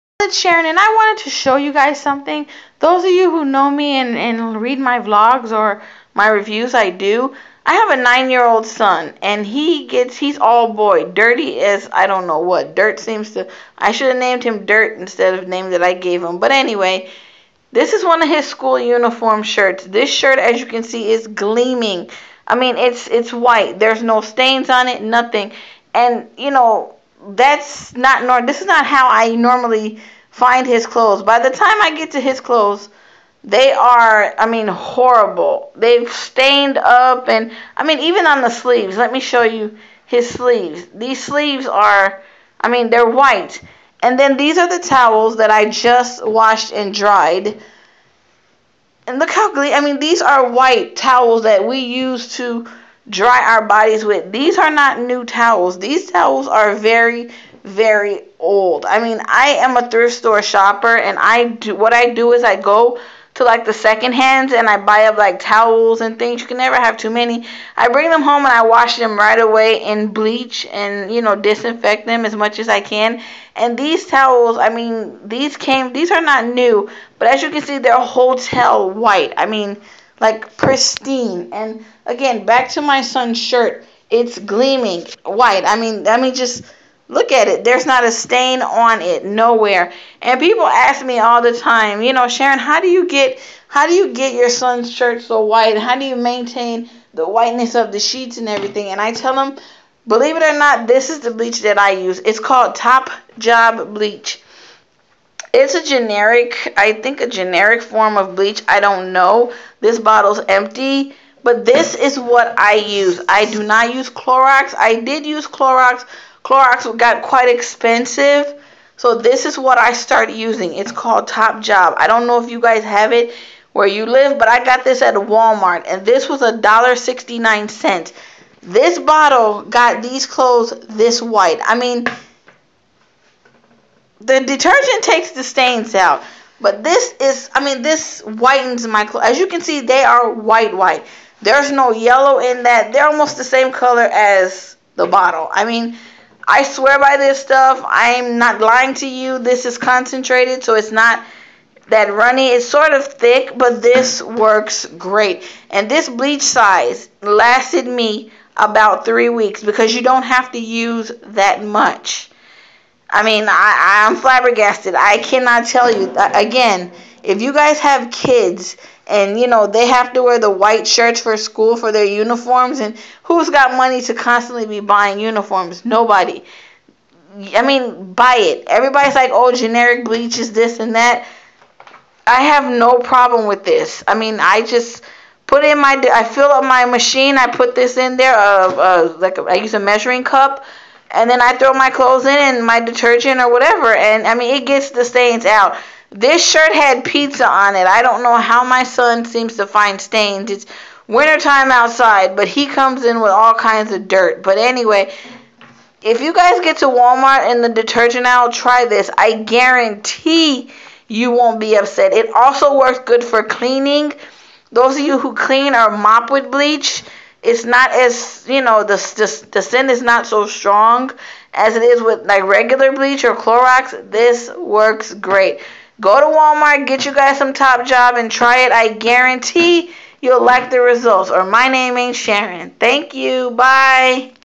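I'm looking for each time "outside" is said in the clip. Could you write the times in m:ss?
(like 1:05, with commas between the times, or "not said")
3:21.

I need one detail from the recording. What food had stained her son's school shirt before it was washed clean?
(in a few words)
Pizza.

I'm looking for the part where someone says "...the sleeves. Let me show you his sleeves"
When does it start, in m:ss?
0:38.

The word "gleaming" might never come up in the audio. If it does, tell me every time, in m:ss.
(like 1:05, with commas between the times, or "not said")
0:21, 1:24.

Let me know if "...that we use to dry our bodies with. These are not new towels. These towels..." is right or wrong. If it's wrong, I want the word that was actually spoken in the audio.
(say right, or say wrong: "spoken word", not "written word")
right.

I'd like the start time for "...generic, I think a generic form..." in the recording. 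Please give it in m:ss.
1:45.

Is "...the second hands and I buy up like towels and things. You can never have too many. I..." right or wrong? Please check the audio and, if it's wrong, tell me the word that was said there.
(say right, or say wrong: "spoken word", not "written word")
right.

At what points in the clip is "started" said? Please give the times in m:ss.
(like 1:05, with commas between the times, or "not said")
1:59.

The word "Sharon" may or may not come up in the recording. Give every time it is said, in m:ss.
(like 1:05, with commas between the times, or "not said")
0:00, 1:32, 3:52.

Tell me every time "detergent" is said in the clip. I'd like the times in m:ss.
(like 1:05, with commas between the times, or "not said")
2:14, 3:12, 3:27.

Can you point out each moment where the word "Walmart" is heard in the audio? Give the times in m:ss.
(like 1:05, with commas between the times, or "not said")
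2:05, 3:26, 3:46.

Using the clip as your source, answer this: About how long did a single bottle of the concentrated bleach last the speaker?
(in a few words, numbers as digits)
About 3 weeks.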